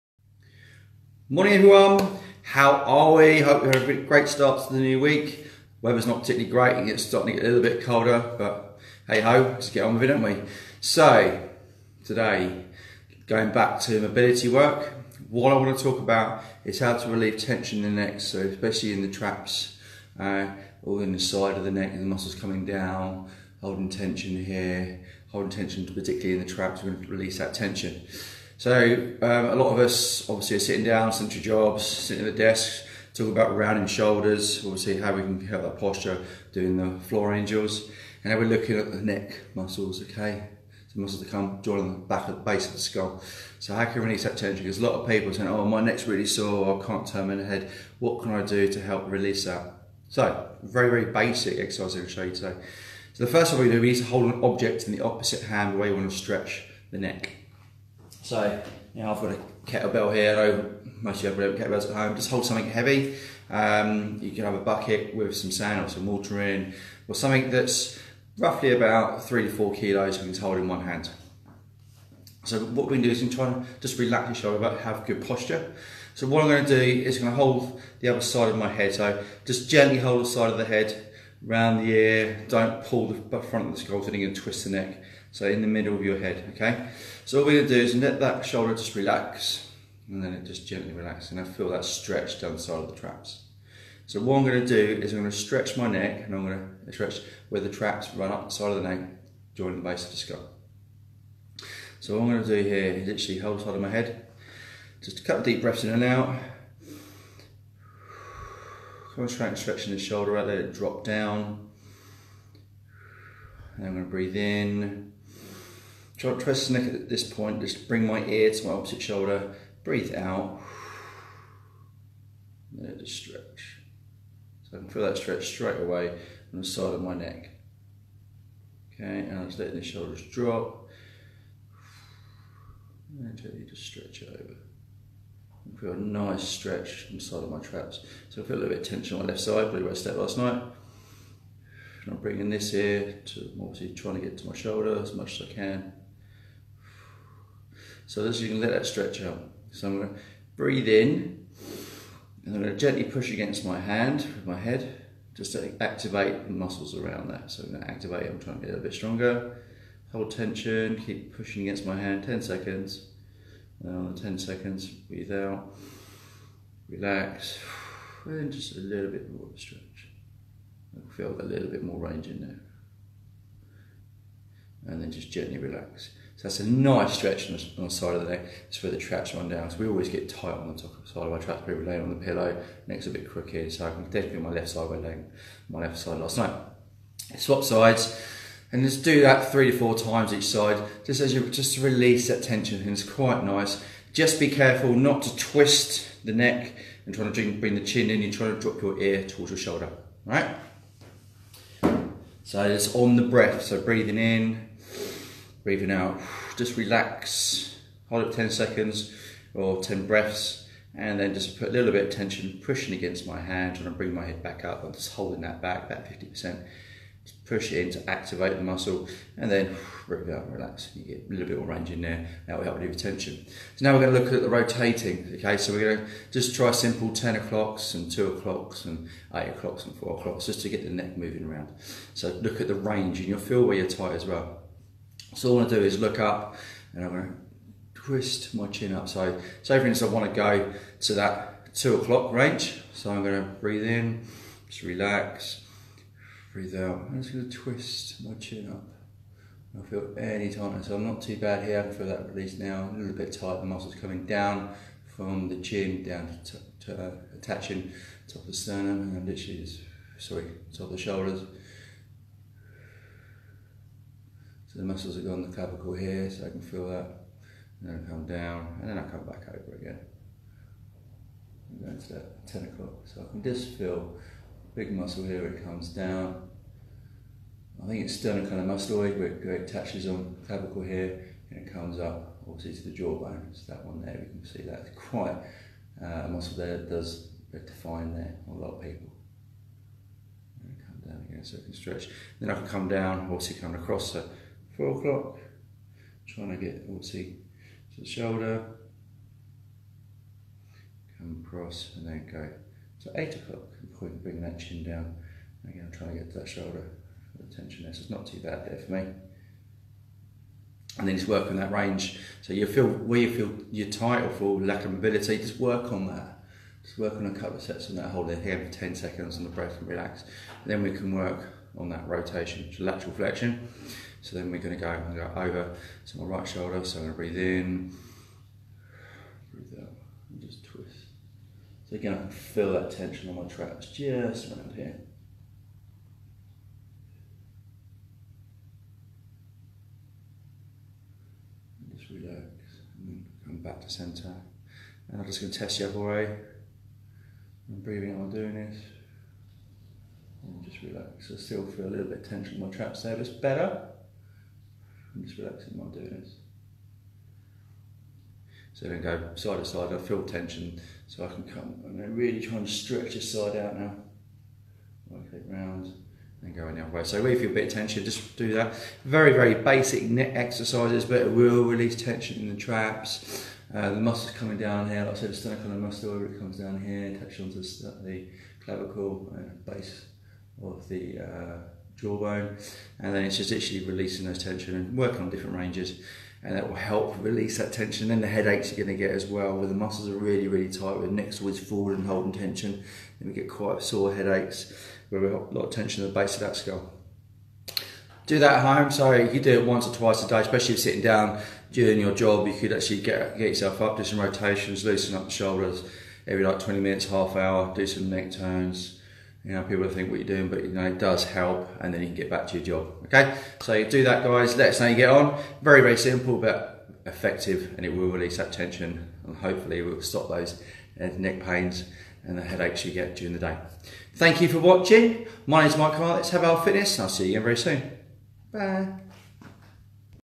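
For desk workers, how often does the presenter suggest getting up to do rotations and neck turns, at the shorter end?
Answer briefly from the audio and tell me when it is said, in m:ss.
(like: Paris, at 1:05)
20 minutes, at 6:46.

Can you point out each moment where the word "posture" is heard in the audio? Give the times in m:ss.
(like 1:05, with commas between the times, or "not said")
0:35, 1:15.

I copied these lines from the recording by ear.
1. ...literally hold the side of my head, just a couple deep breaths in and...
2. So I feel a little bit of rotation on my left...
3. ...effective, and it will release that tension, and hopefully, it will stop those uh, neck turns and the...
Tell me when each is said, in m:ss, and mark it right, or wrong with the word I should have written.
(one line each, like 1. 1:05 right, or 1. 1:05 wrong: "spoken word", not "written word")
1. 1:43 right
2. 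2:18 wrong: "tension", not "rotation"
3. 6:57 wrong: "pains", not "turns".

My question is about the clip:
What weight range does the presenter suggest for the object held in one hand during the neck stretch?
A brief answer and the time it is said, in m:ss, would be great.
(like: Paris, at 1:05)
3 to 4 kilos, at 1:09.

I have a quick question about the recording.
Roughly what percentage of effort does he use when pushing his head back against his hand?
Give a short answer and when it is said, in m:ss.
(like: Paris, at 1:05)
50%, at 3:36.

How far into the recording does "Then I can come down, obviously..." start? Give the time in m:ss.
4:52.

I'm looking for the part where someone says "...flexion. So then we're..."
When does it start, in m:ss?
5:23.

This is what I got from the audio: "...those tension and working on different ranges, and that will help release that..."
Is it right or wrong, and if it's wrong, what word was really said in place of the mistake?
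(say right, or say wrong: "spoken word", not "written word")
right.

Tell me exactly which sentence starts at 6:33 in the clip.
Then we get quite sore headaches, where we have a lot of tension at the base of that skull.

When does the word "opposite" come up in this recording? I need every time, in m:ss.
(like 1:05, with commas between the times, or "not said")
0:55, 1:58.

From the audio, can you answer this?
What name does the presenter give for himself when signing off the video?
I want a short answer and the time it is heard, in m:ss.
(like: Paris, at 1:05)
Mike Carr, at 7:05.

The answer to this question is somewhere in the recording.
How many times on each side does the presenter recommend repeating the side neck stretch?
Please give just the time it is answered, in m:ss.
3:09.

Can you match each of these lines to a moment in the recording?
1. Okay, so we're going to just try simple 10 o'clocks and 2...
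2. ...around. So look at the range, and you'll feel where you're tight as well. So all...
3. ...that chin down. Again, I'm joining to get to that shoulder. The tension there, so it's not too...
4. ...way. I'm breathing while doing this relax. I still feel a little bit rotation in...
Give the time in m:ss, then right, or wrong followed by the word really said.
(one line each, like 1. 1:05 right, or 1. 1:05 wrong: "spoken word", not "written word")
1. 3:45 right
2. 3:51 right
3. 5:04 wrong: "trying", not "joining"
4. 5:45 wrong: "tension", not "rotation".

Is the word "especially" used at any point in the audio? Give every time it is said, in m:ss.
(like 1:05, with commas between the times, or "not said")
0:18, 6:40.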